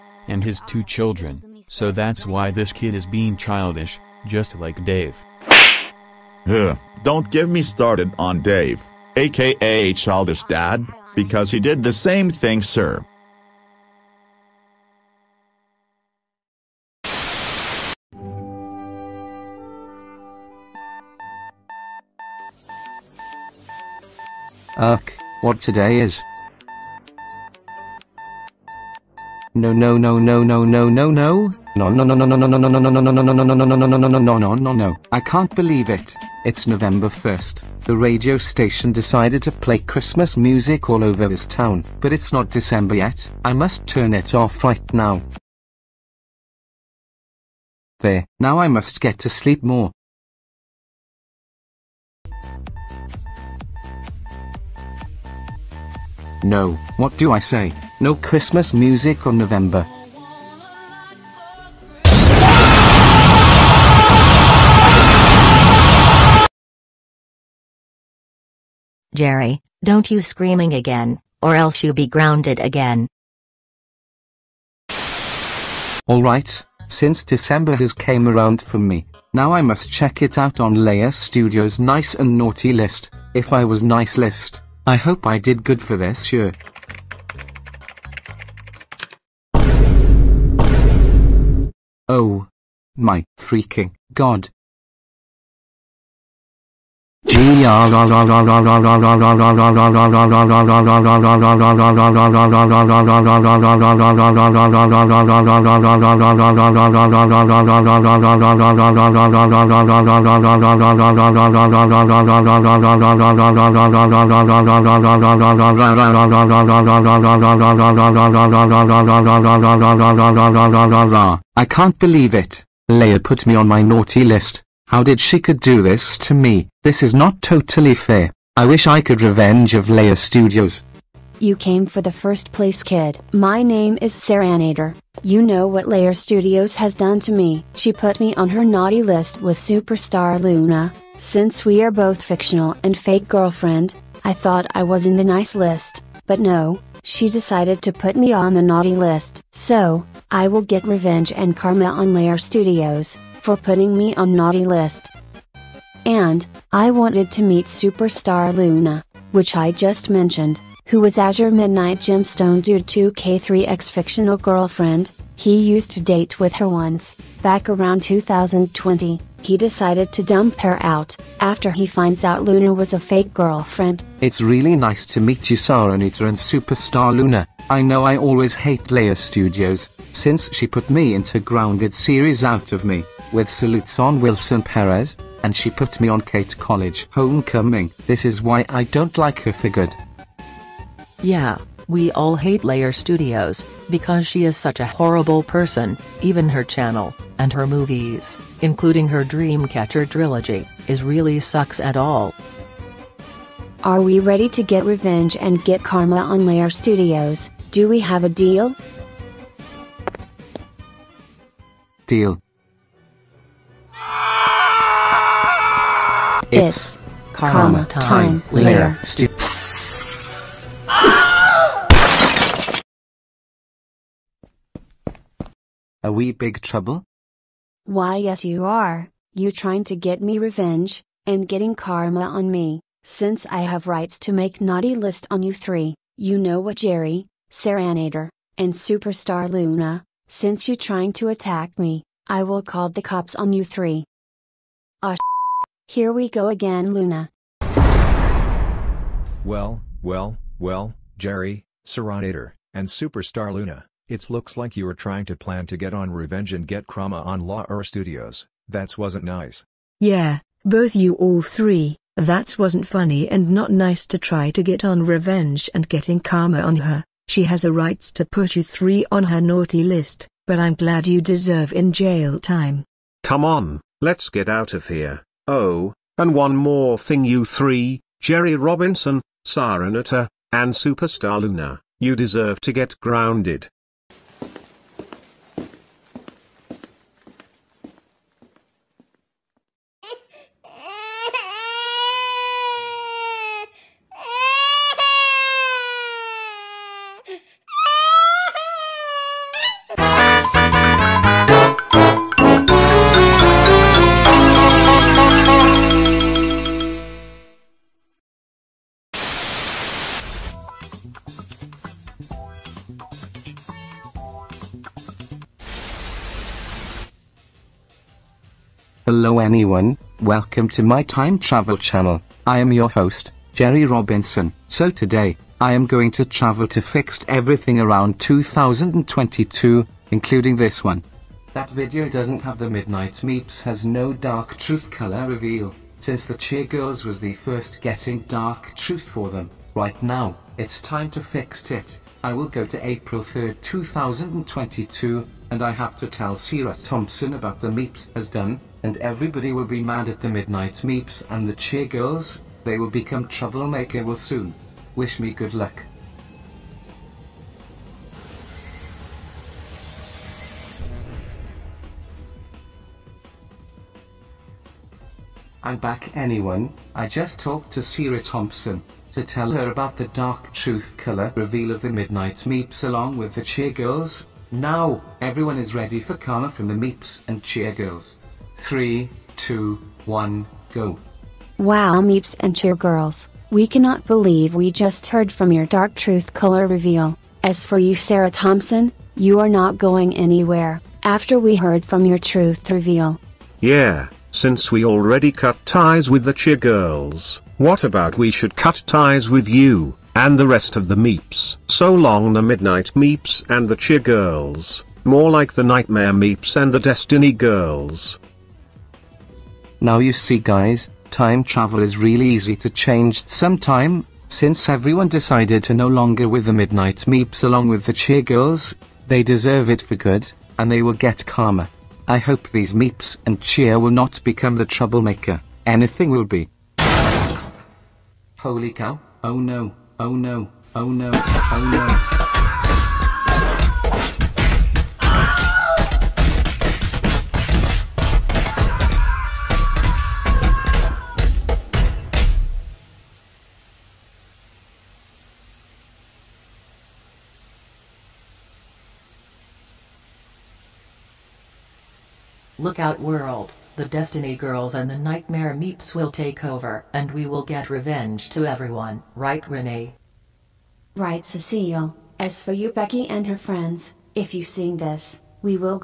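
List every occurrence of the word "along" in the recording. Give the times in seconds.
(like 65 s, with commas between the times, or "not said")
372 s, 417 s.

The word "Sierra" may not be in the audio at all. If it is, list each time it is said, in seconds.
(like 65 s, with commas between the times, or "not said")
346 s, 367 s.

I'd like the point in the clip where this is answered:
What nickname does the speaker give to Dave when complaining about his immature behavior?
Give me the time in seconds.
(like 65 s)
9 s.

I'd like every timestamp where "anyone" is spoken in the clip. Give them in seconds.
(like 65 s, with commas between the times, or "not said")
319 s, 366 s.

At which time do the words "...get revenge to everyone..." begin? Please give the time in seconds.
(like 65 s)
457 s.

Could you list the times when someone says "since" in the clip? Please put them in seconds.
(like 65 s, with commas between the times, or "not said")
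76 s, 141 s, 180 s, 233 s, 240 s, 335 s, 394 s, 414 s.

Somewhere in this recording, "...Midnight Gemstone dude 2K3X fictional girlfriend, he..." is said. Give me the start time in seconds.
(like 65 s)
161 s.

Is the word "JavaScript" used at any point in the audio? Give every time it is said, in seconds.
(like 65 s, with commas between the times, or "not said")
not said.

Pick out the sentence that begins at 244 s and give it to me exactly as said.
Ah here we go again, Luna.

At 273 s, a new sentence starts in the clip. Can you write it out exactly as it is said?
Come on, let's get out of here.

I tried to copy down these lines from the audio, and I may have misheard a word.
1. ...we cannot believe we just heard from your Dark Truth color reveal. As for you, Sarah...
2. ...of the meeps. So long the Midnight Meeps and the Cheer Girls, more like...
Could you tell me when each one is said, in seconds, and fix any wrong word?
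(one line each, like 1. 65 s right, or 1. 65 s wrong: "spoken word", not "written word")
1. 383 s right
2. 400 s right.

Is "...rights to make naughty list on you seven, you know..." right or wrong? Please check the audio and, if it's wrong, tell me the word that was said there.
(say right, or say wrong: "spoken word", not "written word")
wrong: "three", not "seven".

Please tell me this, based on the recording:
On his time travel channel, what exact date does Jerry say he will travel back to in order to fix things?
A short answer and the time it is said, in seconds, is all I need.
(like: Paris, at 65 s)
April 3, 2022, at 342 s.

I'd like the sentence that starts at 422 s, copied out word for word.
I hope these Meeps and Cheer will not become the troublemaker, anything will be.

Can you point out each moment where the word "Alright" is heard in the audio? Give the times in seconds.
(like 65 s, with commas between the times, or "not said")
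76 s.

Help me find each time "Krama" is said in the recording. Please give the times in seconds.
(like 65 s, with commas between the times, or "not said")
256 s.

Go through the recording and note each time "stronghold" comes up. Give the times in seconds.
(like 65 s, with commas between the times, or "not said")
not said.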